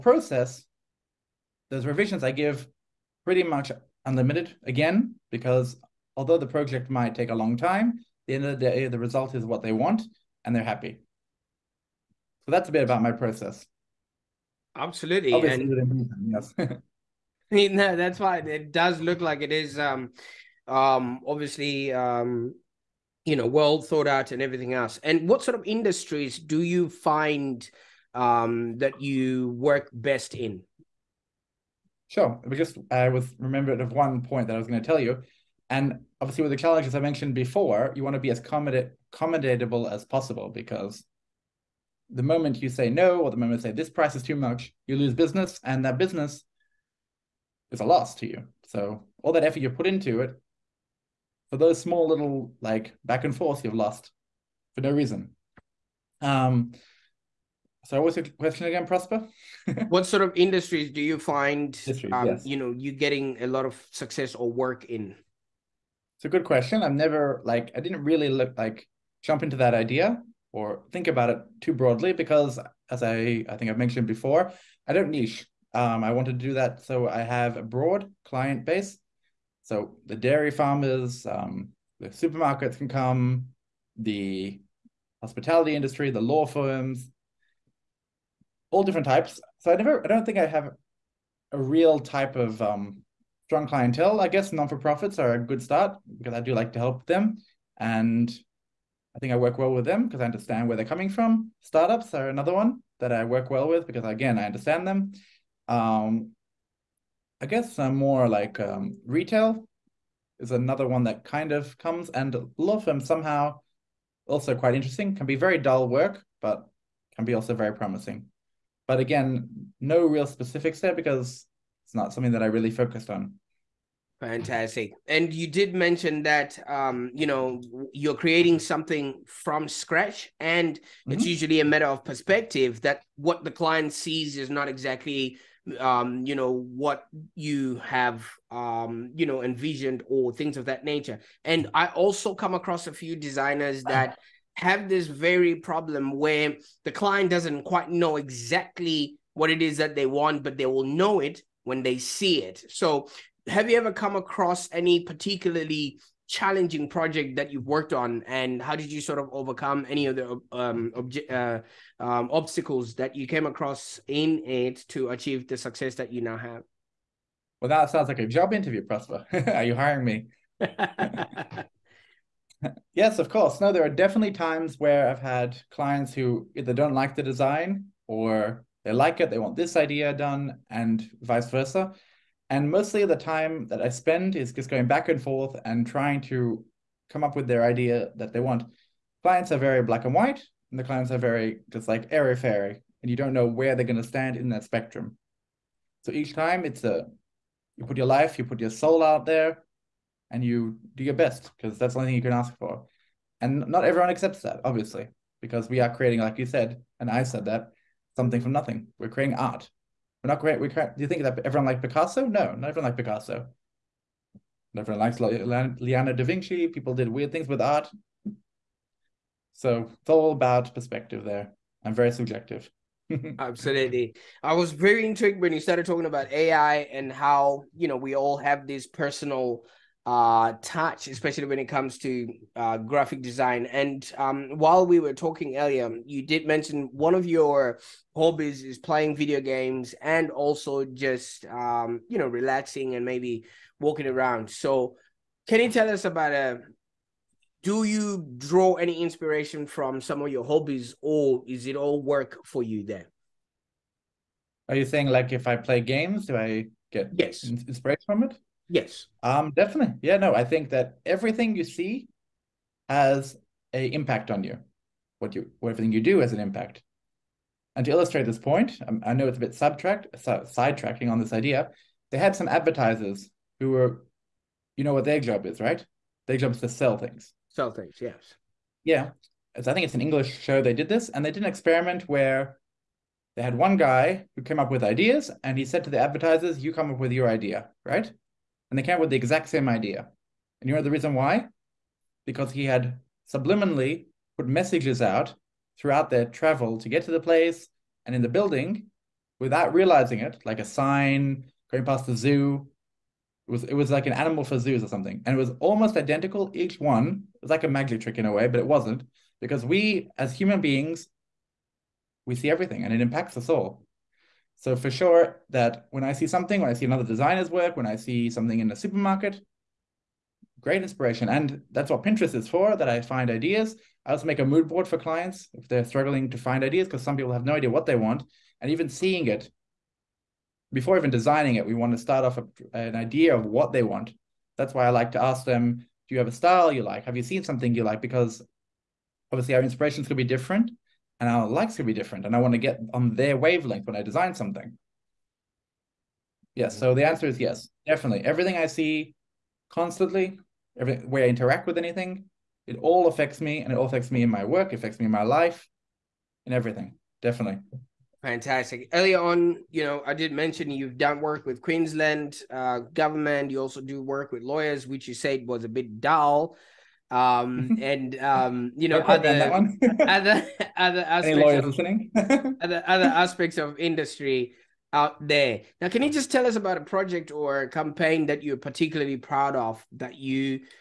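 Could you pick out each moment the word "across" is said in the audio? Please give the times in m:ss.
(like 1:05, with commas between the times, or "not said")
2:22, 2:34, 2:43.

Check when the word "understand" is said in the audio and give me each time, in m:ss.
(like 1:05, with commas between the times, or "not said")
1:40, 1:44.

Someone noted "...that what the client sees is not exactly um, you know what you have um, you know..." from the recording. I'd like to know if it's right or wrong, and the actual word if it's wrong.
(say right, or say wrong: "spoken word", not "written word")
right.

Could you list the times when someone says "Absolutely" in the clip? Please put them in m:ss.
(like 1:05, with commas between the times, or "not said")
0:14, 3:43.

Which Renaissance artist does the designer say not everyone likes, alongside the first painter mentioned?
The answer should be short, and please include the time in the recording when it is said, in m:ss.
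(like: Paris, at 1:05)
Leonardo da Vinci, at 3:35.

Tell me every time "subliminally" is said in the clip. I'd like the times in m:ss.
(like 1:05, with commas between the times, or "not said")
4:53.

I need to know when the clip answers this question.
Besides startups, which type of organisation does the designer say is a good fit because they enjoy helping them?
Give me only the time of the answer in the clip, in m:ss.
1:34.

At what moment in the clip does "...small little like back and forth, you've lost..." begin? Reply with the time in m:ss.
0:51.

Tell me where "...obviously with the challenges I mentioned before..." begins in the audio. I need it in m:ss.
0:36.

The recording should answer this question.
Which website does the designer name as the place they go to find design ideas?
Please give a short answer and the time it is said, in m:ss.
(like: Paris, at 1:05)
Pinterest, at 5:22.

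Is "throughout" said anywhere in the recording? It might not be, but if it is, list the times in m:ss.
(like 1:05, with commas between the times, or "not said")
4:55.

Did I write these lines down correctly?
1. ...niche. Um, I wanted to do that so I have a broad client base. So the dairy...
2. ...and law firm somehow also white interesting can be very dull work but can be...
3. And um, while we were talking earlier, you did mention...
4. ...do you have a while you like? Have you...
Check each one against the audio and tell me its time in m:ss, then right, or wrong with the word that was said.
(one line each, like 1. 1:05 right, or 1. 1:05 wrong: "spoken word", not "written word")
1. 1:15 right
2. 1:52 wrong: "quite", not "white"
3. 3:53 right
4. 5:36 wrong: "style", not "while".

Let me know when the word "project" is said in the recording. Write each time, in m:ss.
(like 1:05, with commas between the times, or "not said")
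0:06, 2:36, 6:16.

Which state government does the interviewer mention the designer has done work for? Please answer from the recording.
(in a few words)
Queensland.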